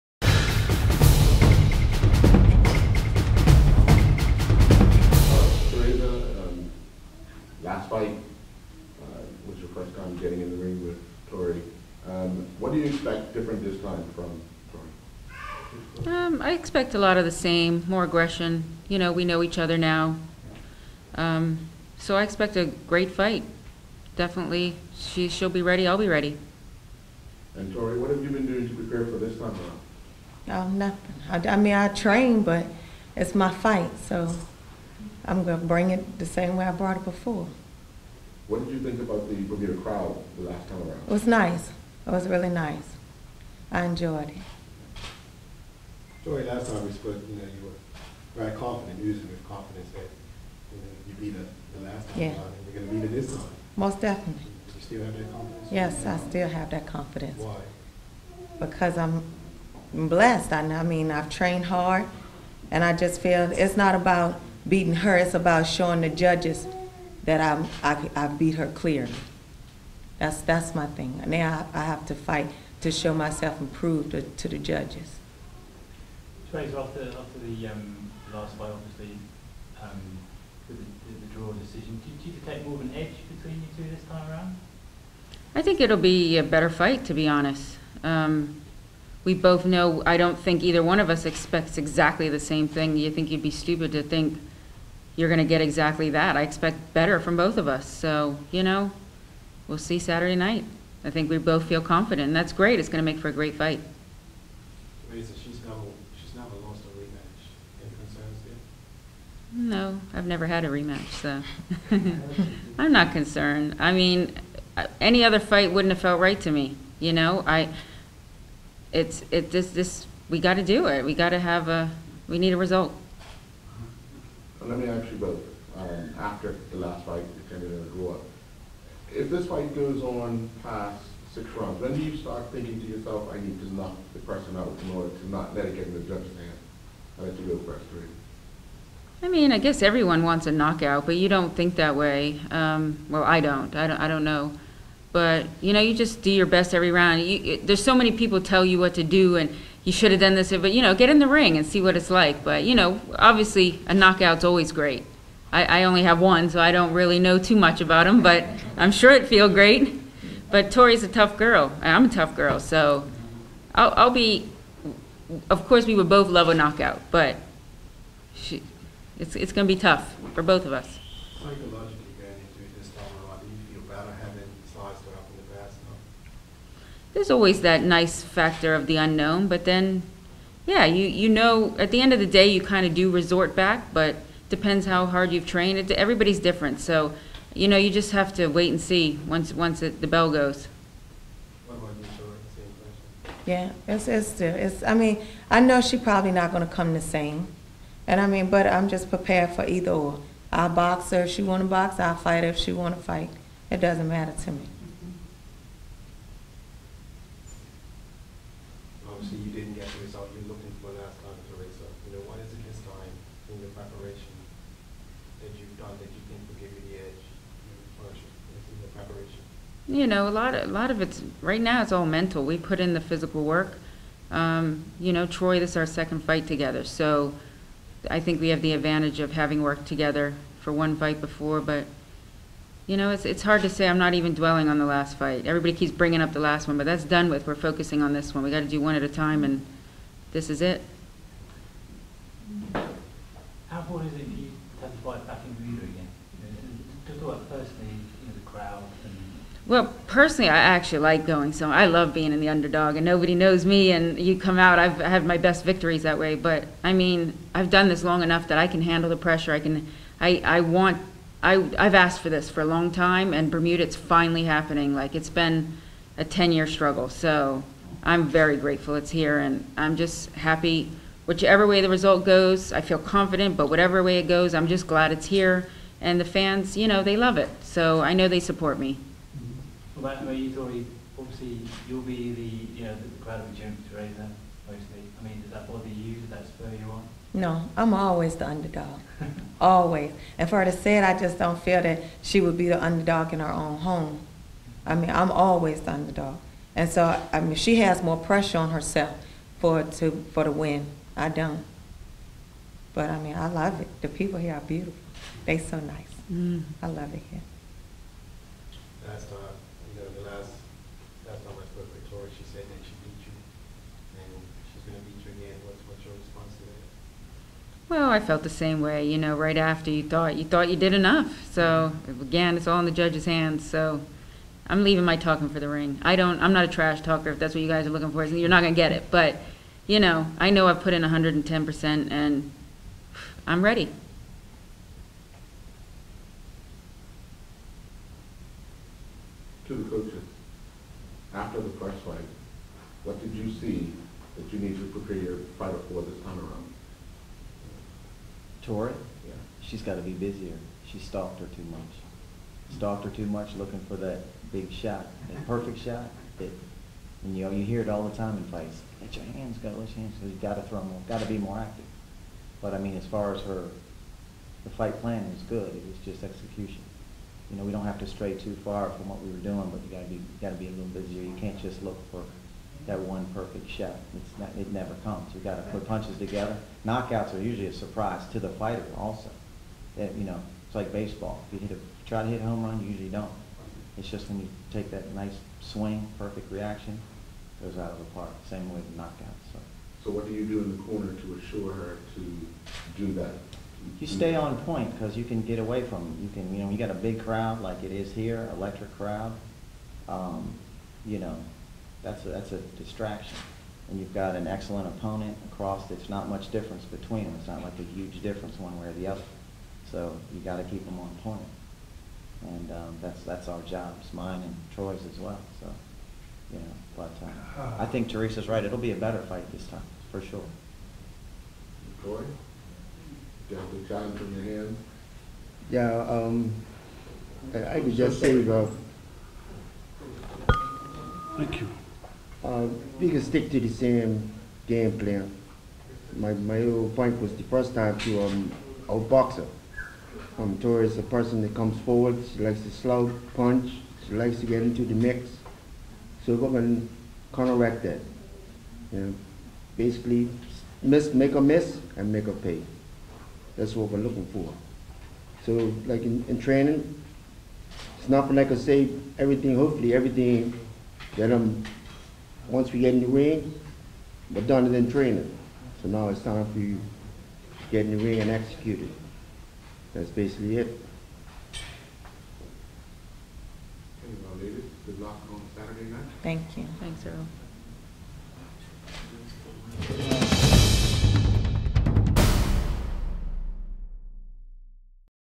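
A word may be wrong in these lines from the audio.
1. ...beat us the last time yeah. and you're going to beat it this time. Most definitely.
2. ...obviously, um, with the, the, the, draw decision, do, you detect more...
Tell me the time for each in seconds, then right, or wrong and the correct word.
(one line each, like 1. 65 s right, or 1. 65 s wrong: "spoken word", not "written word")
1. 51 s right
2. 78 s right.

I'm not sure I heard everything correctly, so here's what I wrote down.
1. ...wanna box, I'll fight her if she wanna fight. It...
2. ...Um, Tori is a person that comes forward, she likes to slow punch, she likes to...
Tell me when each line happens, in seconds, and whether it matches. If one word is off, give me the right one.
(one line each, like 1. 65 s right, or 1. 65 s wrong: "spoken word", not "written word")
1. 201 s right
2. 440 s right.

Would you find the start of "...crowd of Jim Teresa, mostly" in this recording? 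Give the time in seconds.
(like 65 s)
283 s.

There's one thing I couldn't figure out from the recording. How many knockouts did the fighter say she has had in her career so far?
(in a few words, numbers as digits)
1.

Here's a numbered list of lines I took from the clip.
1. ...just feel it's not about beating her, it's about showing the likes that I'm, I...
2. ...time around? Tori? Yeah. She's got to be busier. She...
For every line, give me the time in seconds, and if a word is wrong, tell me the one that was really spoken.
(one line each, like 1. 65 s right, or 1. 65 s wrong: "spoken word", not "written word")
1. 62 s wrong: "judges", not "likes"
2. 346 s right.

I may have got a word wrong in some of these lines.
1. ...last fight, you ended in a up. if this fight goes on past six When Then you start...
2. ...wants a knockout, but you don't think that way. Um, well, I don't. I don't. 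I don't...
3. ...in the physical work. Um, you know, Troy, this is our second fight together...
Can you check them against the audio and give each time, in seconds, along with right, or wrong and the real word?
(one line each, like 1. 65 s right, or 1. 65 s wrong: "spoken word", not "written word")
1. 126 s right
2. 140 s right
3. 222 s right.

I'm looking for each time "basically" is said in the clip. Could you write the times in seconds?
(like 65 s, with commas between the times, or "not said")
449 s, 470 s.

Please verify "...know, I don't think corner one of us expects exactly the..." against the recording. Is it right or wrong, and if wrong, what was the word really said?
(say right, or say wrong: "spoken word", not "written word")
wrong: "either", not "corner".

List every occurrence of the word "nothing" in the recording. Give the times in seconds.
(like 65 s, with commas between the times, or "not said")
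30 s, 458 s.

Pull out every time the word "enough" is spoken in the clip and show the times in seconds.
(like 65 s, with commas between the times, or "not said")
258 s, 320 s.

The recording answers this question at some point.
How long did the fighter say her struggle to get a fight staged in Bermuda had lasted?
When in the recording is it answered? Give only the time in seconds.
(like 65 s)
266 s.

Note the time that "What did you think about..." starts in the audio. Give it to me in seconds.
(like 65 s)
38 s.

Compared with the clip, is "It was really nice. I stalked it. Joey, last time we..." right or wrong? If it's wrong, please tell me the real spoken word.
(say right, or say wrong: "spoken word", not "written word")
wrong: "enjoyed", not "stalked".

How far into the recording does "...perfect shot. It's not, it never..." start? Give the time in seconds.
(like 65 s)
373 s.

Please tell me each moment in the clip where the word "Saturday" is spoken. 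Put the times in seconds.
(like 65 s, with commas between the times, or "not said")
99 s, 475 s.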